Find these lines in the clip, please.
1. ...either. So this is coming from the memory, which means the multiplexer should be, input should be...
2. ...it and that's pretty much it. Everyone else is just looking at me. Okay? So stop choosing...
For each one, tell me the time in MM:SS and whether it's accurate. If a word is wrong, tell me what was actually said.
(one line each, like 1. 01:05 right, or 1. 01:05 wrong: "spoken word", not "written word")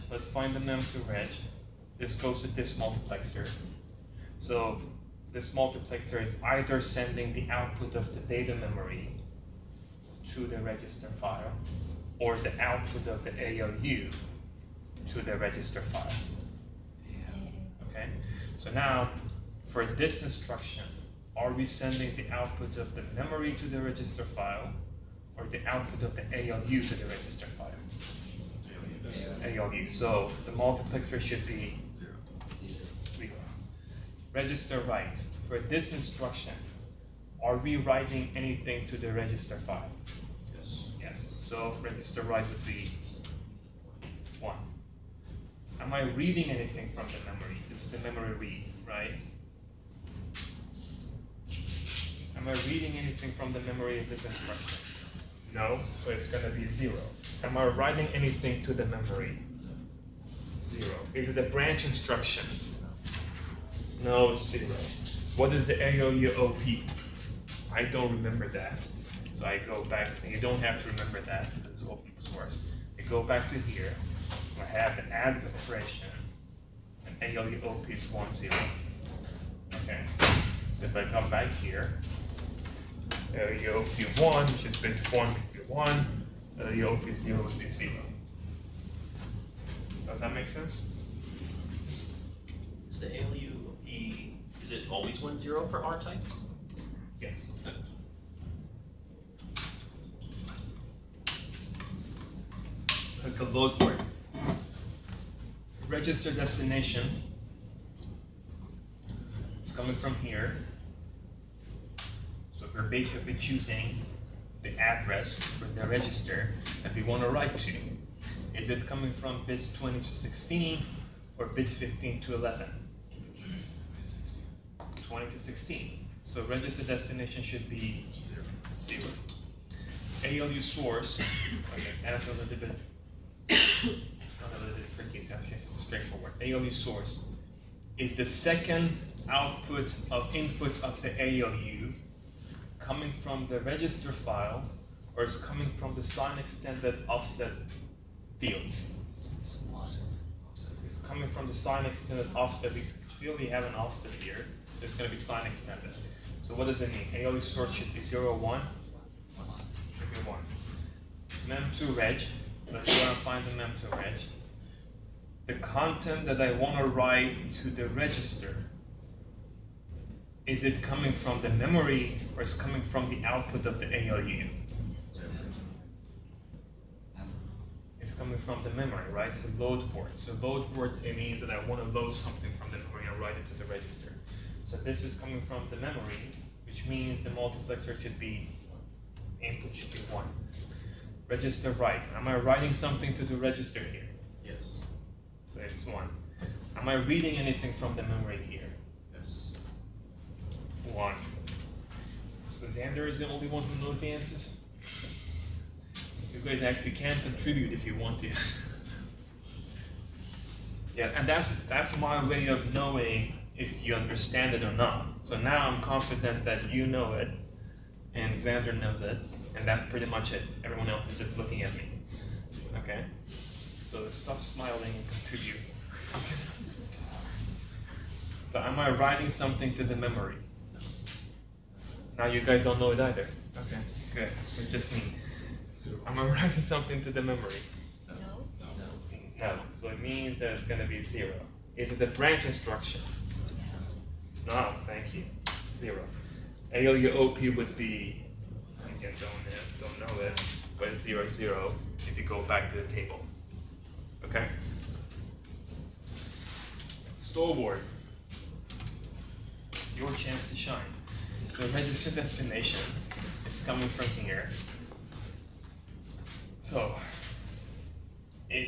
1. 03:03 wrong: "register", not "either"
2. 03:39 wrong: "smiling", not "choosing".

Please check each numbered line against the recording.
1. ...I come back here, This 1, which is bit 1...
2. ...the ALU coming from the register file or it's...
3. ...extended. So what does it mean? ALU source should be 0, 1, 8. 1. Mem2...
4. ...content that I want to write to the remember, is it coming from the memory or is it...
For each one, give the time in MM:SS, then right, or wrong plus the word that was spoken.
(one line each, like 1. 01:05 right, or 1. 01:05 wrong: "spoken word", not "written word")
1. 01:20 wrong: "ALUOP", not "This"
2. 02:21 right
3. 02:35 wrong: "1", not "8"
4. 02:45 wrong: "register", not "remember".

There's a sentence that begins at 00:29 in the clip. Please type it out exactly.
So the multiplexer should be zero.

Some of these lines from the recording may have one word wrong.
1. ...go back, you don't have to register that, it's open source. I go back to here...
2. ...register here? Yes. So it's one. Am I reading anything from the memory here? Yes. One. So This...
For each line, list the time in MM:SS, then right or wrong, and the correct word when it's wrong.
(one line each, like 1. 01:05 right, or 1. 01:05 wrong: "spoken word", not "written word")
1. 01:09 wrong: "remember", not "register"
2. 03:13 wrong: "Xander", not "This".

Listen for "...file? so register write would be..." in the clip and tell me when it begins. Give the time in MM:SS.
00:39.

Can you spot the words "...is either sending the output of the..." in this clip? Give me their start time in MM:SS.
00:06.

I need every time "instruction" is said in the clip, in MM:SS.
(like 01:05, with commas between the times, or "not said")
00:20, 00:35, 00:54, 01:01, 04:02.